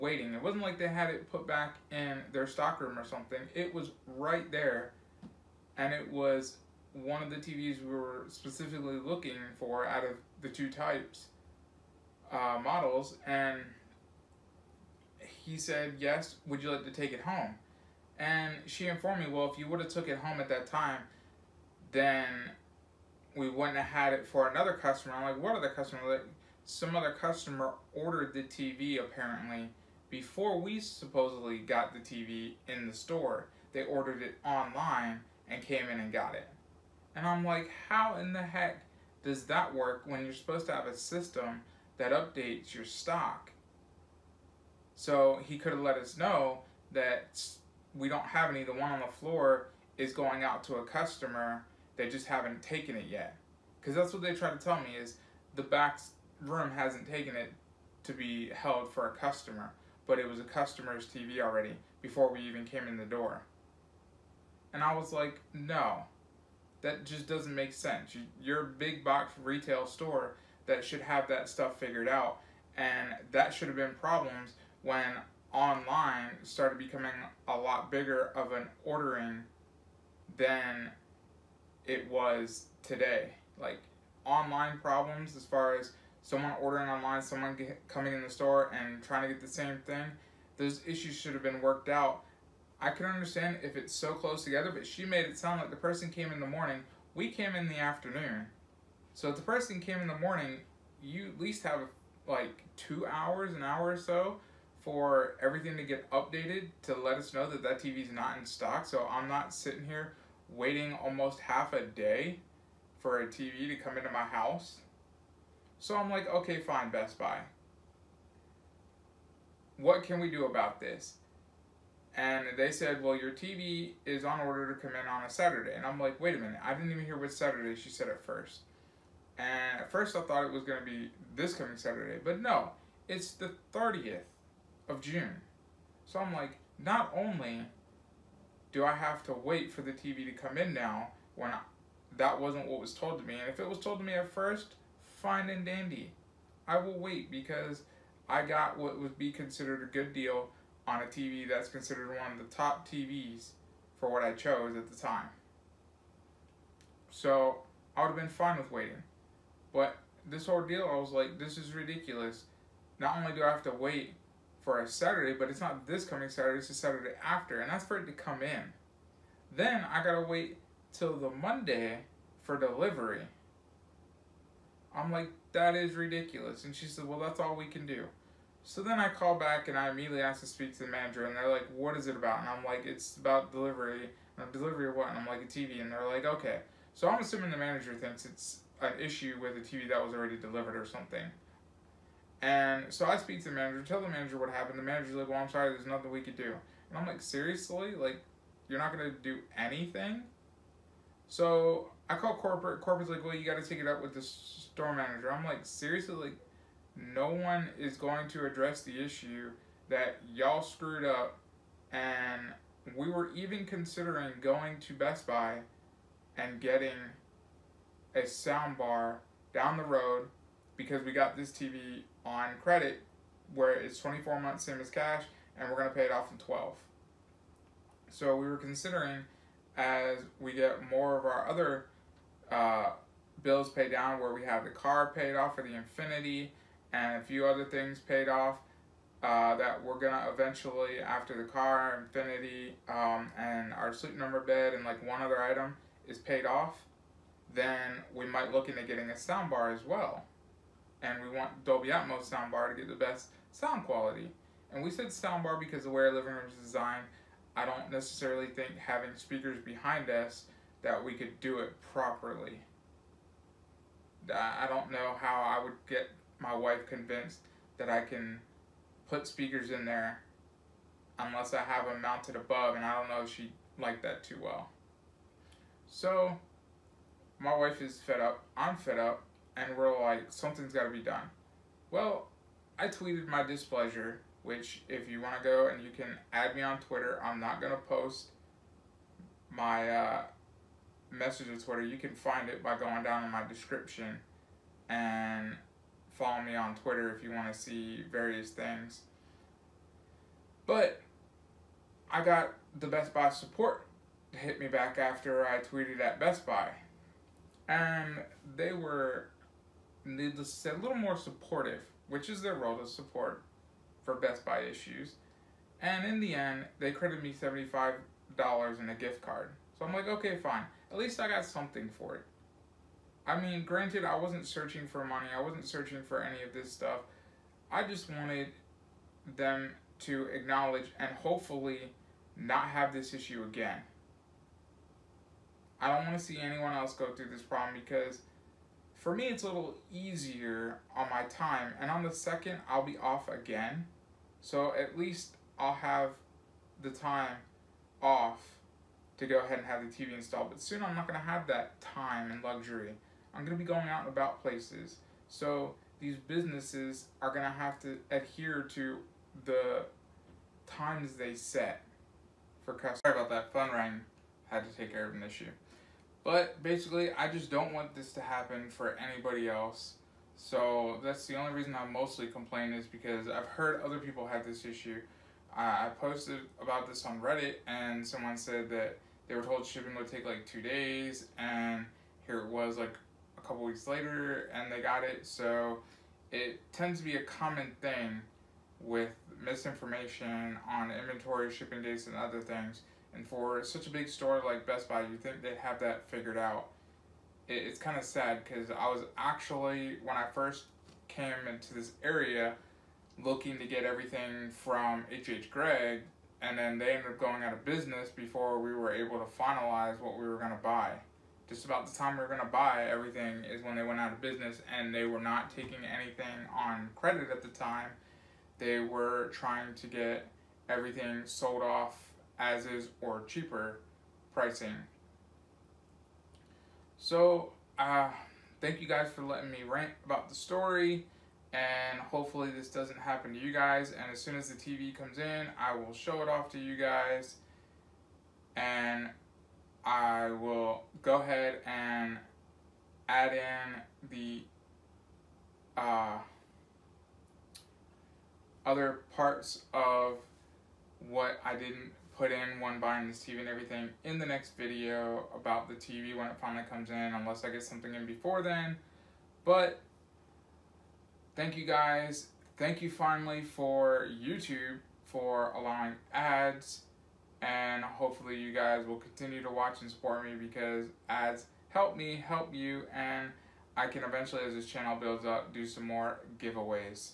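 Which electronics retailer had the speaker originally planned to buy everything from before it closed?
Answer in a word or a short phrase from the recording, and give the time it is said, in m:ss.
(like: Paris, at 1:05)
H.H. Gregg, at 6:45.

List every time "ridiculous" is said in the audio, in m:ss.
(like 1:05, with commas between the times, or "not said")
2:41, 2:55.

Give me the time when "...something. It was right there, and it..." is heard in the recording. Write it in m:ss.
0:03.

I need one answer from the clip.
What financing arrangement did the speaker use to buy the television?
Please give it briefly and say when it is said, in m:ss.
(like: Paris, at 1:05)
24 months same as cash, at 3:43.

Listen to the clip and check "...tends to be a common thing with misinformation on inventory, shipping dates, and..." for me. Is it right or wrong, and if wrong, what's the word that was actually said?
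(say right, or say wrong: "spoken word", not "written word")
right.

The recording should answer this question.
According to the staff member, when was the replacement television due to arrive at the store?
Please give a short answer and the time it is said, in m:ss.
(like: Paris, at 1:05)
June 30th, at 2:13.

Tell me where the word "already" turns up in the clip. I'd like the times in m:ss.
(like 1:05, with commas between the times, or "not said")
1:01, 3:10.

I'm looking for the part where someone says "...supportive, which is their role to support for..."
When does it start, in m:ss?
5:11.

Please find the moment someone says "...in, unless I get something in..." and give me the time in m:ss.
7:36.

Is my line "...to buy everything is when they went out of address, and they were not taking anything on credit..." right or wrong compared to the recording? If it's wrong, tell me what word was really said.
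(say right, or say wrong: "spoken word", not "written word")
wrong: "business", not "address".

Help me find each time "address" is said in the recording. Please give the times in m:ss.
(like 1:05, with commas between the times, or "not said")
3:28.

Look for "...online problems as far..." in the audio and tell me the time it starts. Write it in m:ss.
1:24.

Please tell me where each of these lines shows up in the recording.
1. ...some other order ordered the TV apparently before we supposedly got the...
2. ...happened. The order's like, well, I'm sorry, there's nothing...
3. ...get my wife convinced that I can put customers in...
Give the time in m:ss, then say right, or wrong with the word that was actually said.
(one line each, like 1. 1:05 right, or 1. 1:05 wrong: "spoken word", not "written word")
1. 0:26 wrong: "customer", not "order"
2. 3:14 wrong: "manager", not "order"
3. 4:25 wrong: "speakers", not "customers".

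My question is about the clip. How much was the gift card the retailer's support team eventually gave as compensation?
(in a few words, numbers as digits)
$75.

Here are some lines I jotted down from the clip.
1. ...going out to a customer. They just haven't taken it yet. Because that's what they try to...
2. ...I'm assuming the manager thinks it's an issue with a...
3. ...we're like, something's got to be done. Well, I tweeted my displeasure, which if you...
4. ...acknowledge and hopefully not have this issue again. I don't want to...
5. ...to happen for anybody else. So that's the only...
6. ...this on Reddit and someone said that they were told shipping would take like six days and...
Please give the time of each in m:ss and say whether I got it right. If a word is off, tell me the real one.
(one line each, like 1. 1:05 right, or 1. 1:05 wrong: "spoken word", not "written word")
1. 0:50 right
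2. 3:07 right
3. 4:39 right
4. 5:30 right
5. 6:08 right
6. 6:16 wrong: "two", not "six".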